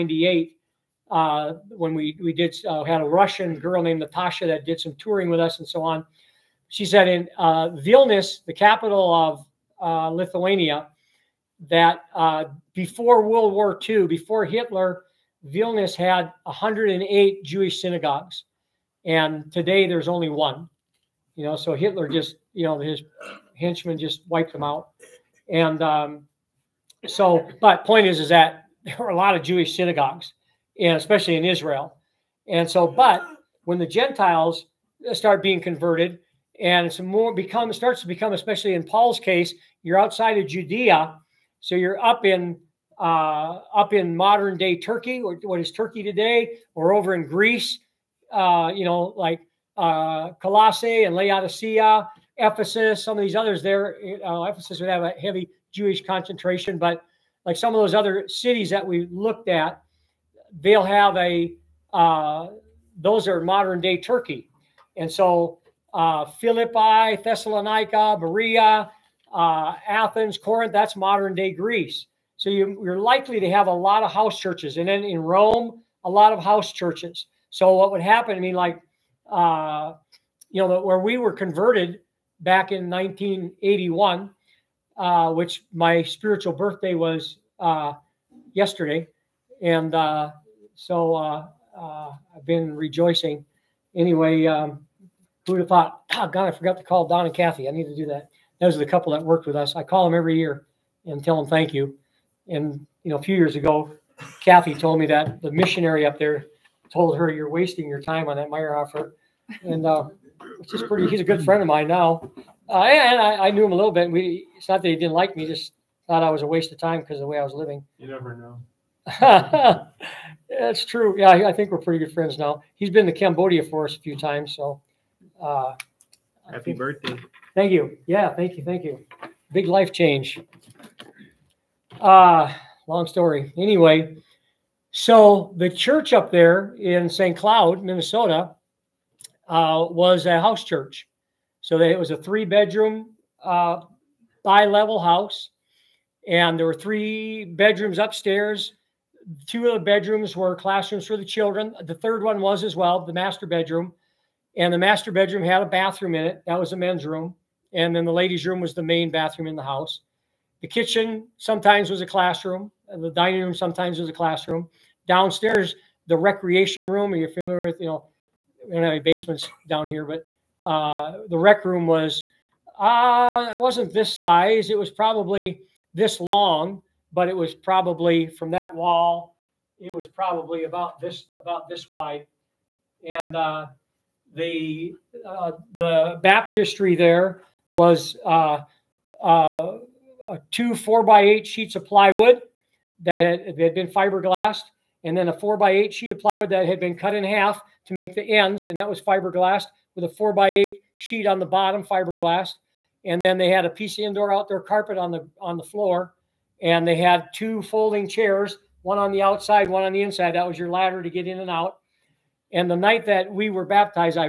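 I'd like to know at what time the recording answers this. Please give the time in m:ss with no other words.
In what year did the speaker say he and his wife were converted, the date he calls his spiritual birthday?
1:22.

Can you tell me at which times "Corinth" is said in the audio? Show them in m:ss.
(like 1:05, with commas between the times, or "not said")
1:10.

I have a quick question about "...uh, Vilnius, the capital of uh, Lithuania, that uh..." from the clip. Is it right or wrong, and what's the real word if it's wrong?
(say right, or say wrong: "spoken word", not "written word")
right.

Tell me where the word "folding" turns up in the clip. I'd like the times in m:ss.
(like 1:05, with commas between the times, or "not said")
3:27.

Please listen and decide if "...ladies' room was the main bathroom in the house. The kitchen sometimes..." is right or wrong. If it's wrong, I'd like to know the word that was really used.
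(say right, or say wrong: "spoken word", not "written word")
right.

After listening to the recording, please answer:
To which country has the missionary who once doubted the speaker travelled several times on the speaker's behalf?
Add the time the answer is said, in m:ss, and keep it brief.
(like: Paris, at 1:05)
Cambodia, at 2:03.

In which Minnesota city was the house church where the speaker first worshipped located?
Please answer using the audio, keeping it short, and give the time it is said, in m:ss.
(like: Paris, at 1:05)
St. Cloud, at 2:17.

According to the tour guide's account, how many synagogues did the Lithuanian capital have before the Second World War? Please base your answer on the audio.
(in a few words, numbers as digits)
108.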